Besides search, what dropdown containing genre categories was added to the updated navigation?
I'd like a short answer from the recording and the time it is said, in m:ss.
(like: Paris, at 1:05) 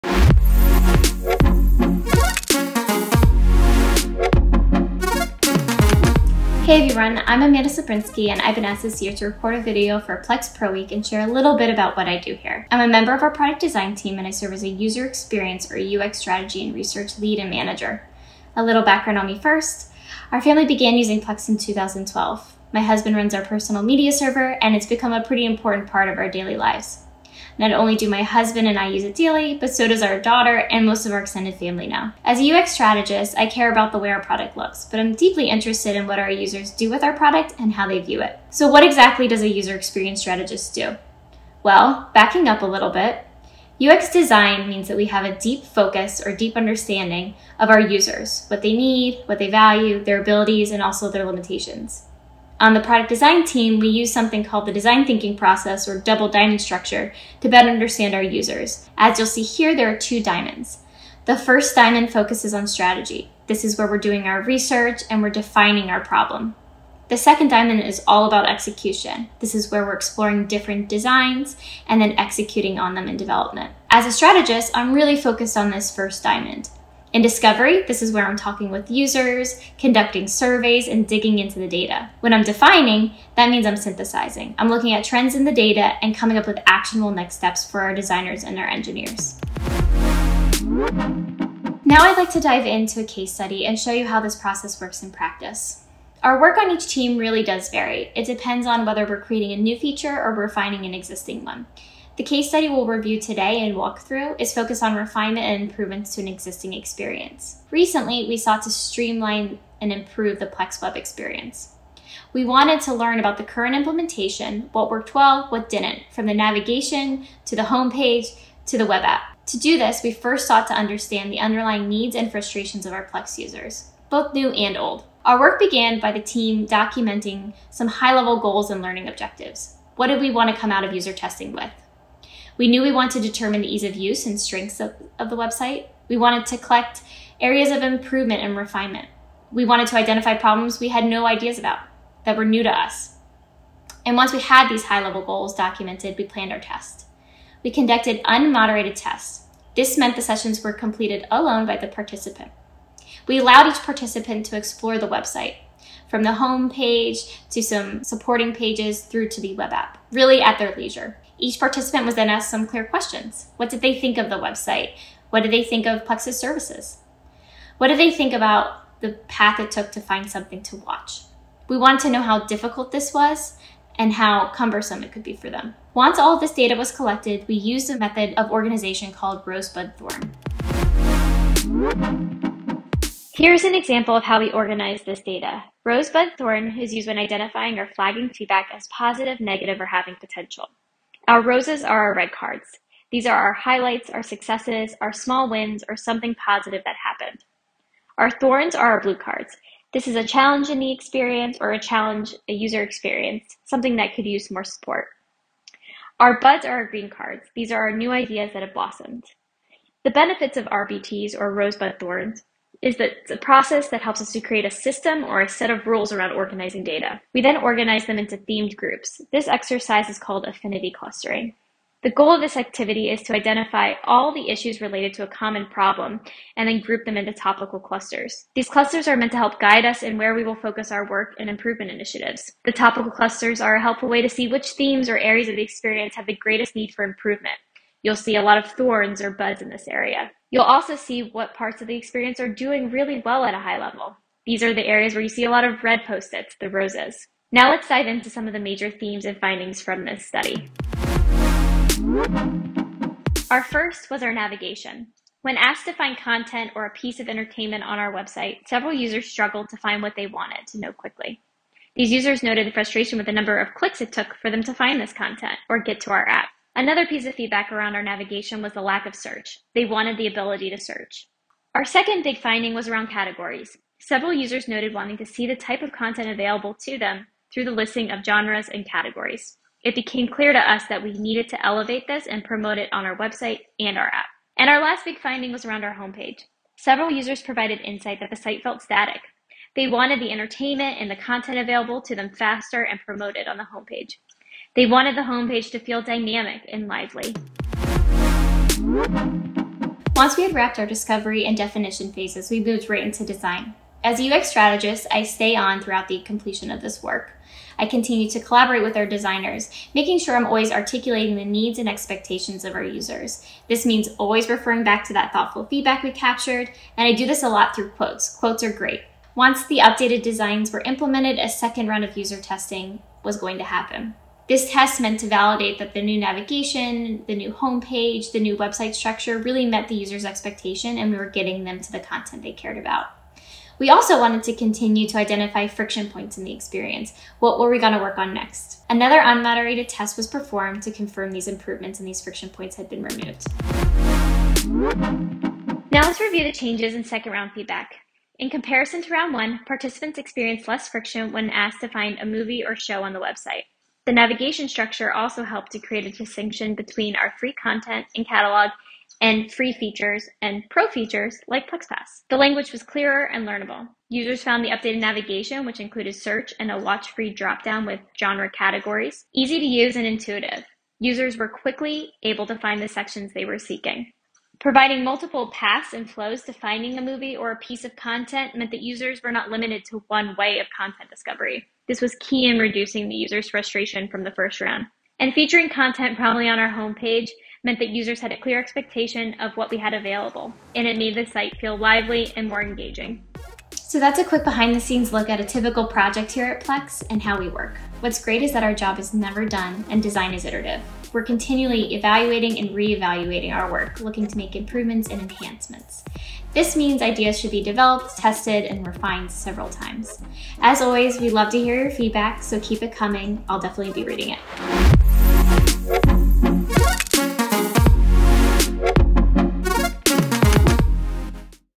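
Watch free, at 6:06.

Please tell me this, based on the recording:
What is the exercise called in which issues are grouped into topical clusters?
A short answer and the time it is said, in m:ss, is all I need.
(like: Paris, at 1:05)
Affinity clustering, at 3:40.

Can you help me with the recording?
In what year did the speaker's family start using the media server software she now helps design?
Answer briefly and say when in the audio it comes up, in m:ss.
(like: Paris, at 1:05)
2012, at 0:21.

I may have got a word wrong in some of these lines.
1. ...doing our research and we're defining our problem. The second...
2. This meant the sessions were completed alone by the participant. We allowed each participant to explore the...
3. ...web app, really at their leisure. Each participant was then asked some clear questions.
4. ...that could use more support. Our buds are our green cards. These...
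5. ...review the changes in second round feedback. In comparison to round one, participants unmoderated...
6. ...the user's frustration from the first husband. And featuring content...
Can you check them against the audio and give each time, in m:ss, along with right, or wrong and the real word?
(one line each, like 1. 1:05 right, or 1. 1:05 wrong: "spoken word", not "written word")
1. 1:03 right
2. 2:29 right
3. 2:39 right
4. 3:23 right
5. 5:46 wrong: "experienced", not "unmoderated"
6. 6:23 wrong: "round", not "husband".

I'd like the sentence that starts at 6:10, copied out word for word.
Users were quickly able to find the sections they were seeking.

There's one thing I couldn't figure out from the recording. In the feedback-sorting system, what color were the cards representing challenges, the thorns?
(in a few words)
Blue.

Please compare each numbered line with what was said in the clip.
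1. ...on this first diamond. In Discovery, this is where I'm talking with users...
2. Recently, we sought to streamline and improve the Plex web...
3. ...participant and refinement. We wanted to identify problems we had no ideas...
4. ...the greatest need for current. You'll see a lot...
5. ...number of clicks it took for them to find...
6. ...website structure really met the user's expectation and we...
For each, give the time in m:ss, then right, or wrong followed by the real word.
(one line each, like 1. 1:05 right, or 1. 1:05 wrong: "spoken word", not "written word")
1. 1:15 right
2. 1:47 right
3. 2:17 wrong: "improvement", not "participant"
4. 3:56 wrong: "improvement", not "current"
5. 4:23 right
6. 5:28 right.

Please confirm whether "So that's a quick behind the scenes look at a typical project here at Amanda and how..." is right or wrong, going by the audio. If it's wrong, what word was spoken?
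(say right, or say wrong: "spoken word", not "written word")
wrong: "Plex", not "Amanda".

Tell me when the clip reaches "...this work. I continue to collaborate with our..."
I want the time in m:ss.
5:06.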